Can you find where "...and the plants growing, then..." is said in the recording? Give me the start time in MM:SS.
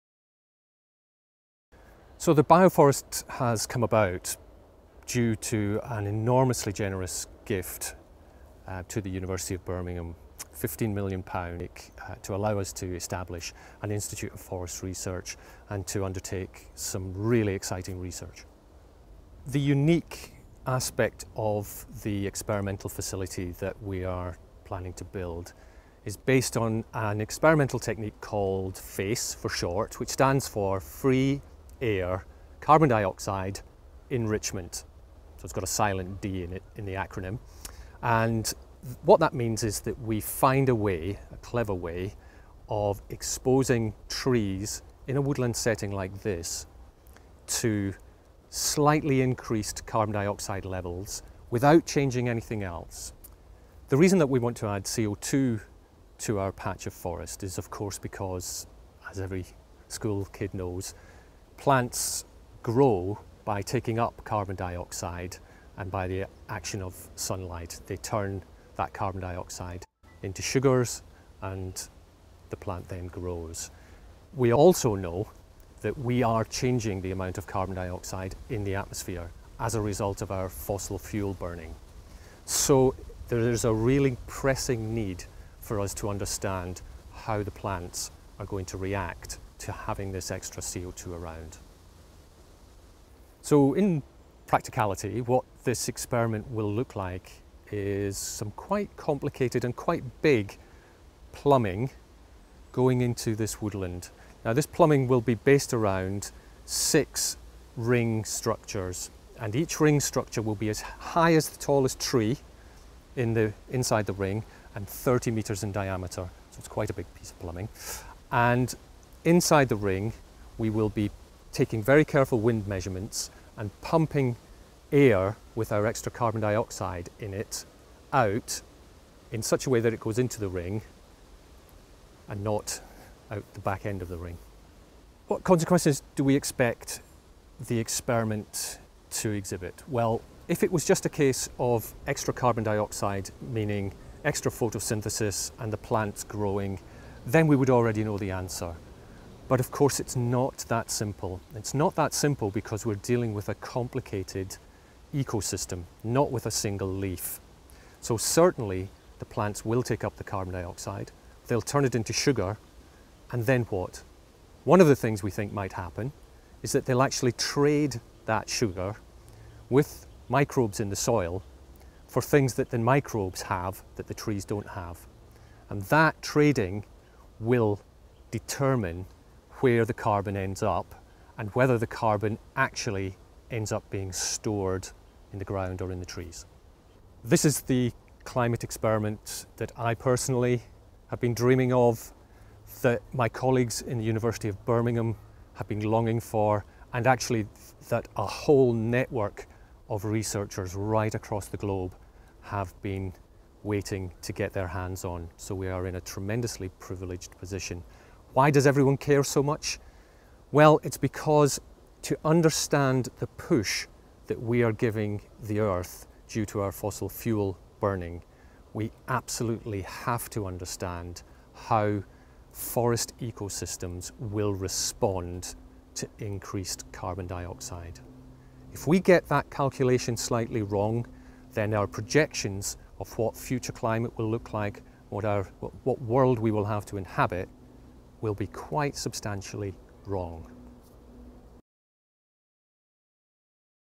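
02:25.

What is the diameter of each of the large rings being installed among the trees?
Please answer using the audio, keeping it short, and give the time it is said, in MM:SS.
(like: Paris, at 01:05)
30 meters, at 01:54.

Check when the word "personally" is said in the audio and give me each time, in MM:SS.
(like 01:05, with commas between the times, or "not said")
03:09.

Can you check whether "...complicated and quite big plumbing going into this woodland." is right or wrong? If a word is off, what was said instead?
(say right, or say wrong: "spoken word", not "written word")
right.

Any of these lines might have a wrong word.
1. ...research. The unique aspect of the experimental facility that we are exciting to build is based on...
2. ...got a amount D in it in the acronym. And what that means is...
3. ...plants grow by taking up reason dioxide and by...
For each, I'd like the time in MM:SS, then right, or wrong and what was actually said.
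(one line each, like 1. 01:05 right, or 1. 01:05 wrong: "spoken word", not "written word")
1. 00:17 wrong: "planning", not "exciting"
2. 00:35 wrong: "silent", not "amount"
3. 01:01 wrong: "carbon", not "reason".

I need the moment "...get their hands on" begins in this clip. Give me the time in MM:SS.
03:24.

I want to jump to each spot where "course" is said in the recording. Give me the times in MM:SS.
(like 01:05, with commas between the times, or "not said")
00:57, 02:29.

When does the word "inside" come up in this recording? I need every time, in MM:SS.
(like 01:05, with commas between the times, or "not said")
01:53, 01:59.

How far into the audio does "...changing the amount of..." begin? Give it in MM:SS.
01:16.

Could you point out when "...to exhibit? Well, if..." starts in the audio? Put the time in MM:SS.
02:19.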